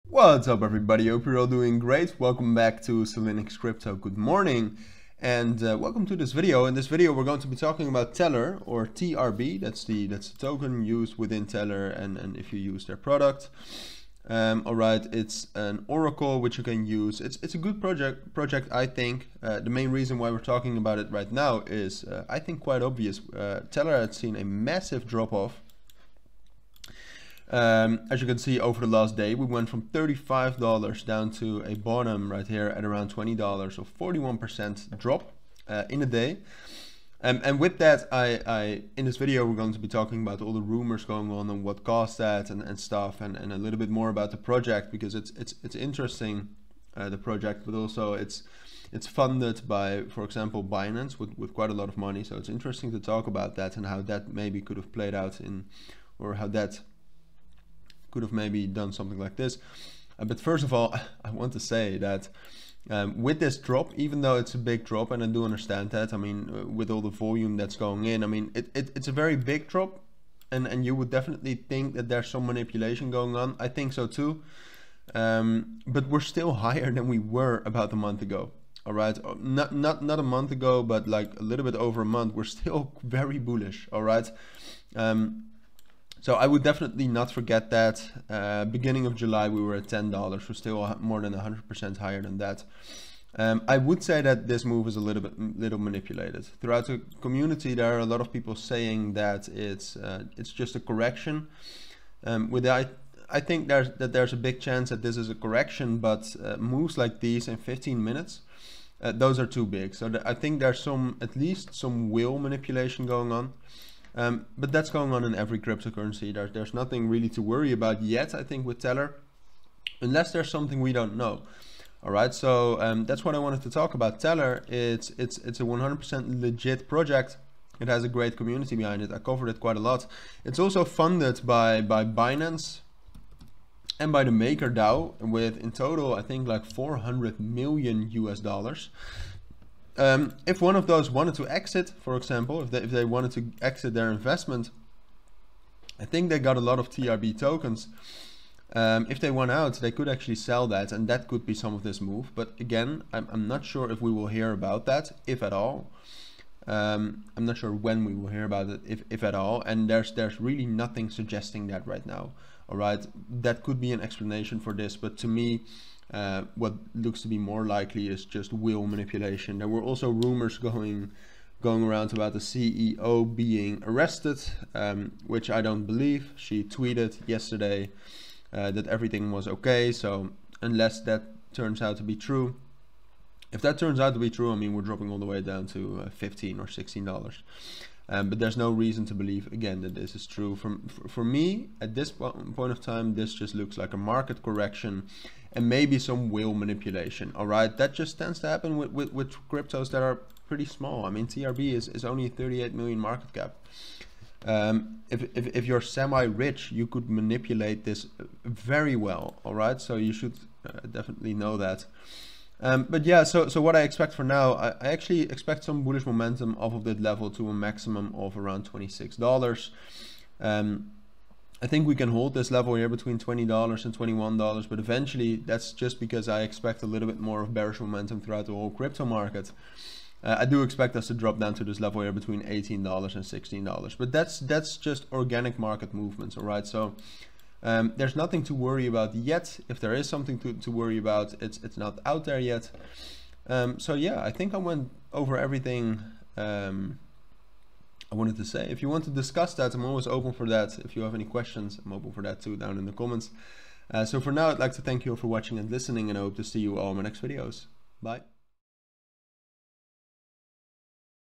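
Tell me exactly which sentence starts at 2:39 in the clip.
And there's there's really nothing suggesting that right now.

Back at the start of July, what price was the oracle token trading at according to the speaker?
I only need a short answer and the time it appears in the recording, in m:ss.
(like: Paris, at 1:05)
$10, at 1:29.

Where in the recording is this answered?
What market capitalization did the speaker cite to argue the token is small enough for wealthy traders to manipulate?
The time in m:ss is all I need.
3:22.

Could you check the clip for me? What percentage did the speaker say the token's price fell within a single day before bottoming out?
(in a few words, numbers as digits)
41%.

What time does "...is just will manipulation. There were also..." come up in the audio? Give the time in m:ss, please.
2:48.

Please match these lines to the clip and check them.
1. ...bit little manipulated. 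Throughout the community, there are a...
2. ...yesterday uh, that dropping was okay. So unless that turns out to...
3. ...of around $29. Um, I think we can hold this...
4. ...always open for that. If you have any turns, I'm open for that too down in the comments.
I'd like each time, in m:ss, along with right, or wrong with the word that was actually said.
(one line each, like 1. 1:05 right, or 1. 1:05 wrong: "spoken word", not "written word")
1. 1:35 right
2. 2:57 wrong: "everything", not "dropping"
3. 3:38 wrong: "26", not "29"
4. 4:09 wrong: "questions", not "turns".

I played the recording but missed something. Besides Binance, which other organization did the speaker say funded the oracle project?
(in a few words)
Maker DAO.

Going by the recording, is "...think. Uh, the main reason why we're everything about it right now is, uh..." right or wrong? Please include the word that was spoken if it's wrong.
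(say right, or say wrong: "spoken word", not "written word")
wrong: "talking", not "everything".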